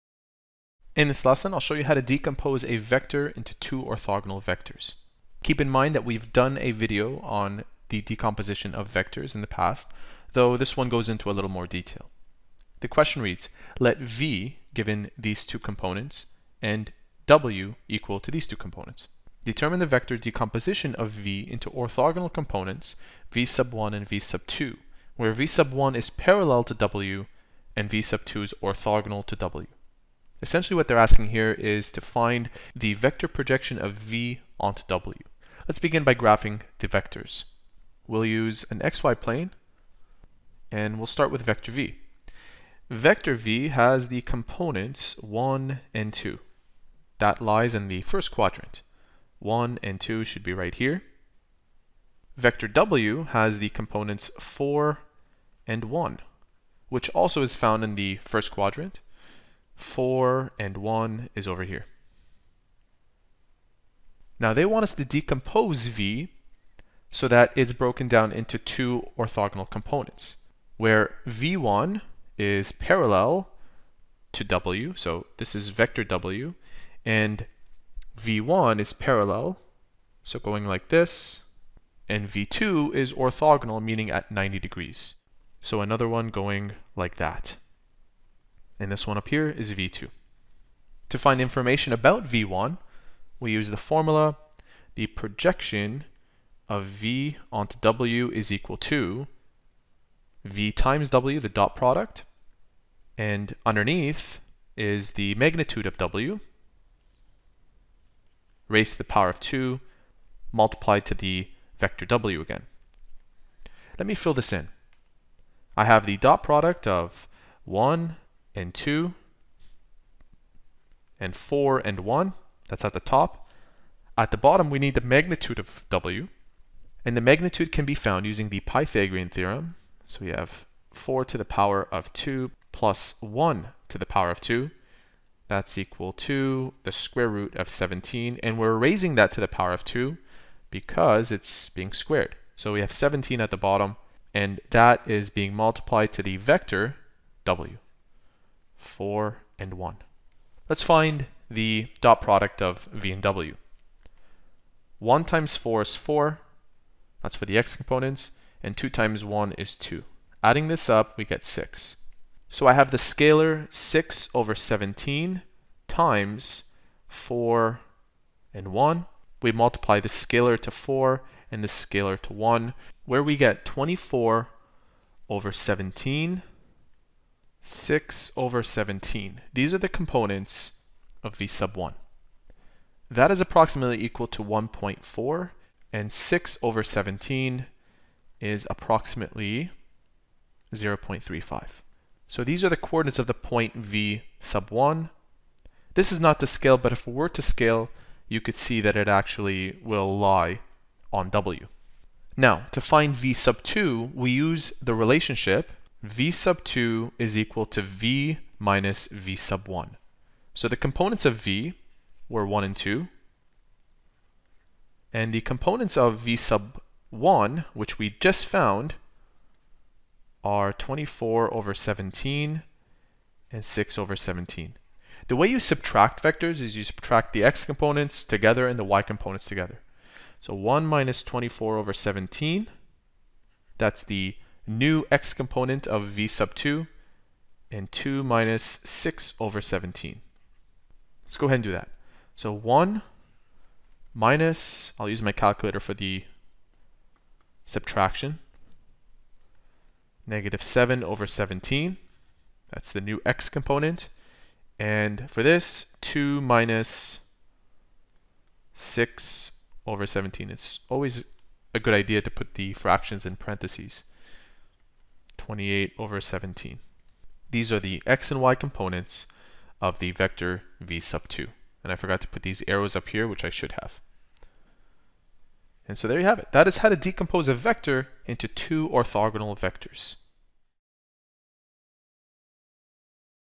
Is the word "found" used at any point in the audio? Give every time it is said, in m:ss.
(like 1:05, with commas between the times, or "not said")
0:57, 2:07, 3:38.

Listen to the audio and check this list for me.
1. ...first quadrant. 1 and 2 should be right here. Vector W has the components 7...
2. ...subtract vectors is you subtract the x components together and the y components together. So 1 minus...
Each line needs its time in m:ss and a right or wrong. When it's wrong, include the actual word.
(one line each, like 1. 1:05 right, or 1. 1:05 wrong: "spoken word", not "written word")
1. 0:48 wrong: "4", not "7"
2. 3:45 right.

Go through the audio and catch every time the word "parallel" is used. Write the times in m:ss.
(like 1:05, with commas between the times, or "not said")
0:26, 1:12, 1:18.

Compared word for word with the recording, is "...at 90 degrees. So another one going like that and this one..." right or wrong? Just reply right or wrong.
right.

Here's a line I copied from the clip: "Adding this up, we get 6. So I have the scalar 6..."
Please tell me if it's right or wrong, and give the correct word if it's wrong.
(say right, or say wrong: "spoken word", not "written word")
right.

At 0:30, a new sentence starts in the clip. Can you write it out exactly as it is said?
Essentially what they're asking here is to find the vector projection of V onto W.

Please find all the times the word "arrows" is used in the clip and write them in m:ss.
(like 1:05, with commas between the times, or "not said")
4:32.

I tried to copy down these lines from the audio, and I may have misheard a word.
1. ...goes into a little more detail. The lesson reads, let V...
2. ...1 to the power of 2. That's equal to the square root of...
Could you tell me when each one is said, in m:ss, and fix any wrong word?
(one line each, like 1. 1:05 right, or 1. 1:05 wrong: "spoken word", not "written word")
1. 0:10 wrong: "question", not "lesson"
2. 2:13 right.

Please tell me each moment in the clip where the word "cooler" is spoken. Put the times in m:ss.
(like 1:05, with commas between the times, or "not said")
not said.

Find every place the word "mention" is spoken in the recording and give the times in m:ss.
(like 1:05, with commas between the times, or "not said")
not said.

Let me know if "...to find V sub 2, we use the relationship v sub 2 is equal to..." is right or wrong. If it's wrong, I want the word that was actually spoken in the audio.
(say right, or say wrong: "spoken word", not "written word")
right.